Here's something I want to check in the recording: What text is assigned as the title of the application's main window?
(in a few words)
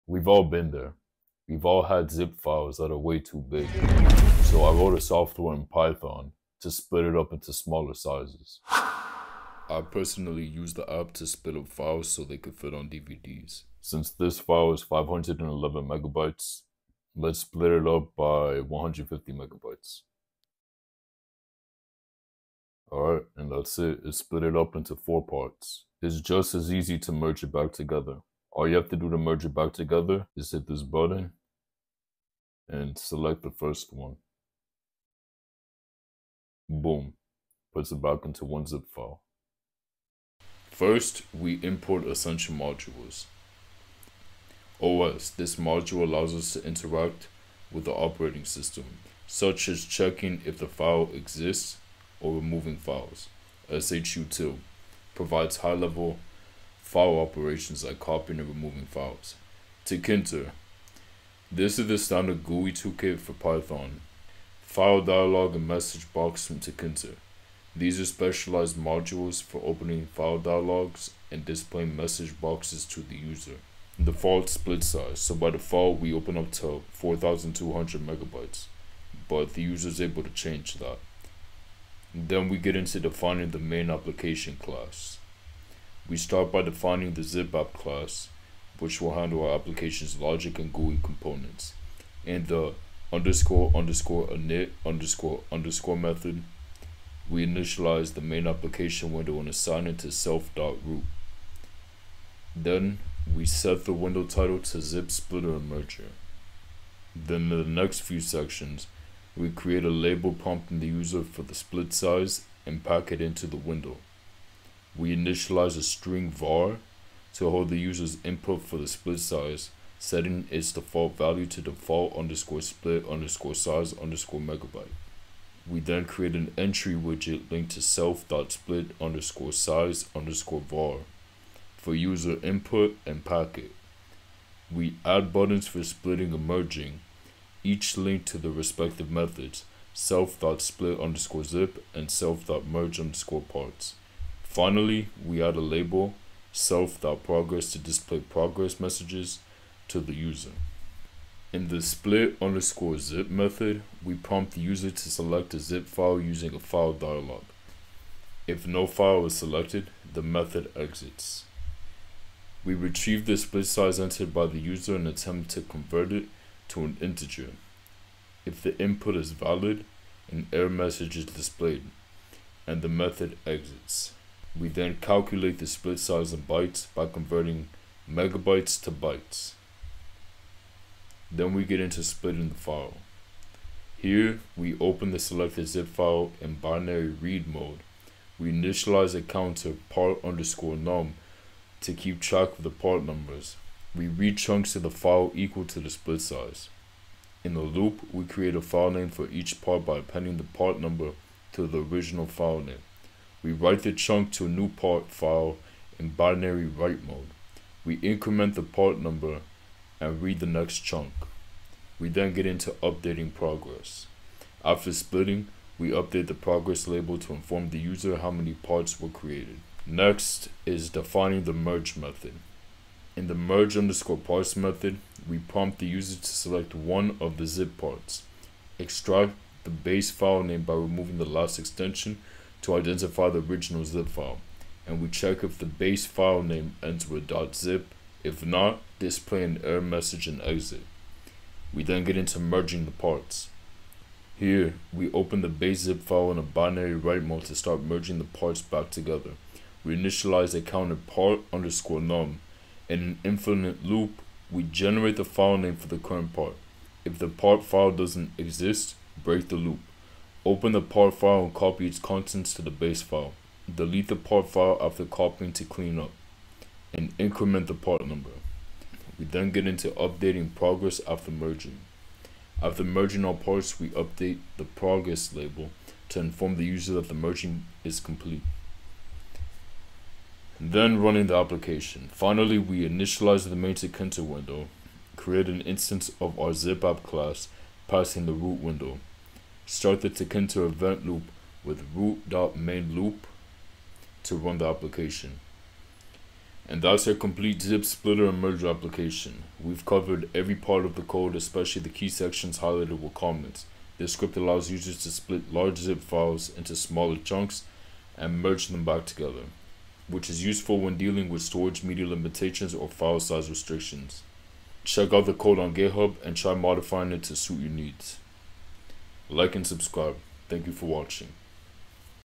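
Zip Splitter Merger.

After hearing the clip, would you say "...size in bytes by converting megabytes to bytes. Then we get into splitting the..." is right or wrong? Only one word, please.
right.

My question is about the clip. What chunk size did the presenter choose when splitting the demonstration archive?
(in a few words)
150 megabytes.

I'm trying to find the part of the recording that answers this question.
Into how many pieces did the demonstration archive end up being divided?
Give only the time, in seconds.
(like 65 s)
24 s.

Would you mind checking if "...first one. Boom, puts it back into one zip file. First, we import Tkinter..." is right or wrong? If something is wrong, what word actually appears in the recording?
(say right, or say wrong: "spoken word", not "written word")
wrong: "Ascension", not "Tkinter".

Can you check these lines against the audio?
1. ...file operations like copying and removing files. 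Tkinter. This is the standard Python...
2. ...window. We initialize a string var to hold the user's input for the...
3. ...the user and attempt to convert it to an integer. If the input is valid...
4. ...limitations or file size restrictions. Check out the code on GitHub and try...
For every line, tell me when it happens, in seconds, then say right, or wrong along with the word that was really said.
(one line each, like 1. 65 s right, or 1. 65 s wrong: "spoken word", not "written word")
1. 56 s wrong: "GUI", not "Python"
2. 113 s right
3. 164 s right
4. 312 s right.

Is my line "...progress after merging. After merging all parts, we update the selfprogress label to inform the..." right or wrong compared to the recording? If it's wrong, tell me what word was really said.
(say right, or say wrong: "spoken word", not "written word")
wrong: "progress", not "selfprogress".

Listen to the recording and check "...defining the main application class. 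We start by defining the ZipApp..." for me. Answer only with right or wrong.
right.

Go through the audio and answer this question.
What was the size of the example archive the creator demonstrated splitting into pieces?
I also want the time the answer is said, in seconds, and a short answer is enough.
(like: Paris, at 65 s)
511 megabytes, at 14 s.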